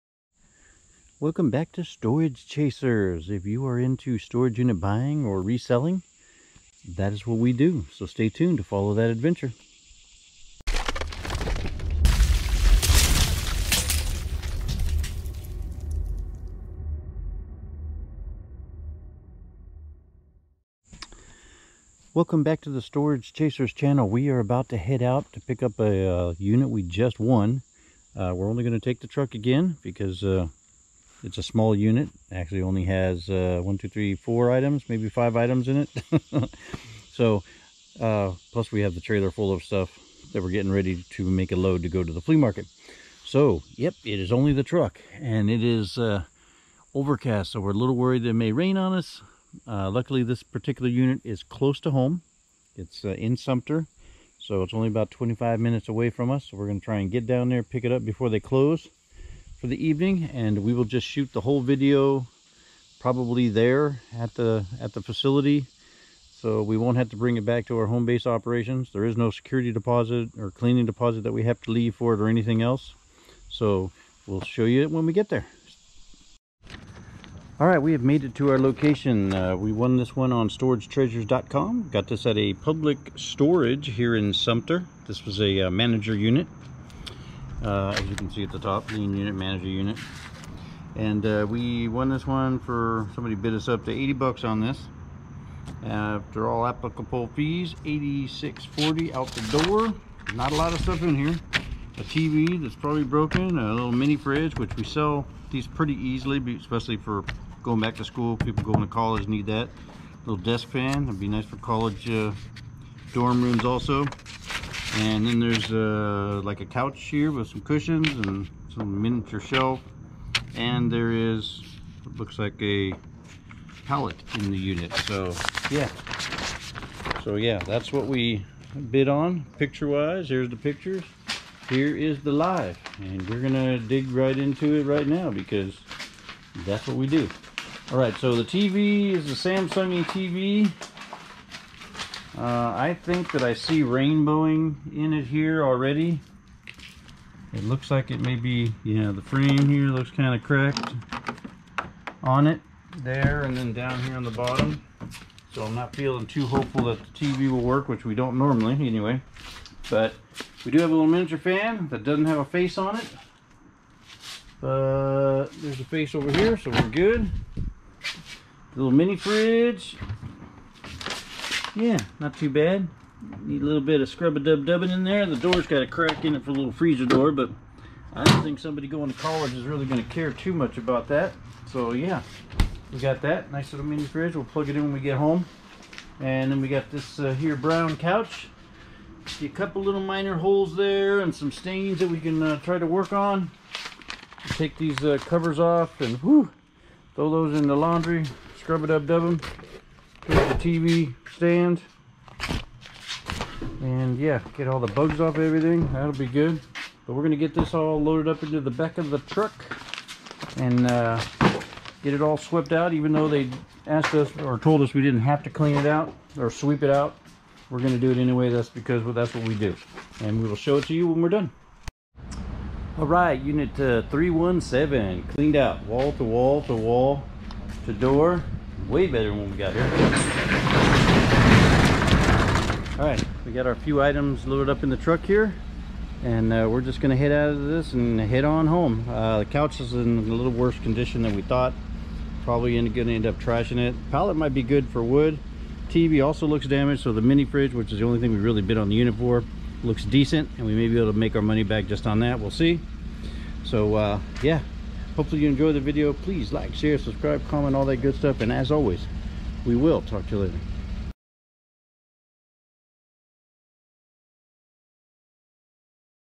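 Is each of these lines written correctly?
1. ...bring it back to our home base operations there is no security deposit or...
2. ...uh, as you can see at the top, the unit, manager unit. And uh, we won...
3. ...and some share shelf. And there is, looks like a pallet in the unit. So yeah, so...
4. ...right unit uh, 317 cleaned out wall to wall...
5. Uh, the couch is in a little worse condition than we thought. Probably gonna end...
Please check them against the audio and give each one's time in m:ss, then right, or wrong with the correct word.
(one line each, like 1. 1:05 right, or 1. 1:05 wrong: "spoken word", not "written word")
1. 1:07 right
2. 1:27 right
3. 1:58 wrong: "miniature", not "share"
4. 3:43 right
5. 3:59 right.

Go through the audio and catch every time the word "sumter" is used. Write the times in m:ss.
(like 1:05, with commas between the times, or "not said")
0:53, 1:24.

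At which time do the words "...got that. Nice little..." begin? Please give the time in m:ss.
3:02.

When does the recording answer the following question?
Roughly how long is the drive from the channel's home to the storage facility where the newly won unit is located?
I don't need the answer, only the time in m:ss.
0:55.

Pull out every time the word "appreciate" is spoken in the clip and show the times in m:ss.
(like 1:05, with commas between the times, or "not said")
not said.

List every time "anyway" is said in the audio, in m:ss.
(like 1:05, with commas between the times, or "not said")
2:38, 3:38.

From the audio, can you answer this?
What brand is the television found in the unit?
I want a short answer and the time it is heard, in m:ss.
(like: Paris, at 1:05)
Samsung, at 2:19.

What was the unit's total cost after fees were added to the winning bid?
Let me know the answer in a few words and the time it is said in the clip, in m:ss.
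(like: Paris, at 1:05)
$86.40, at 1:37.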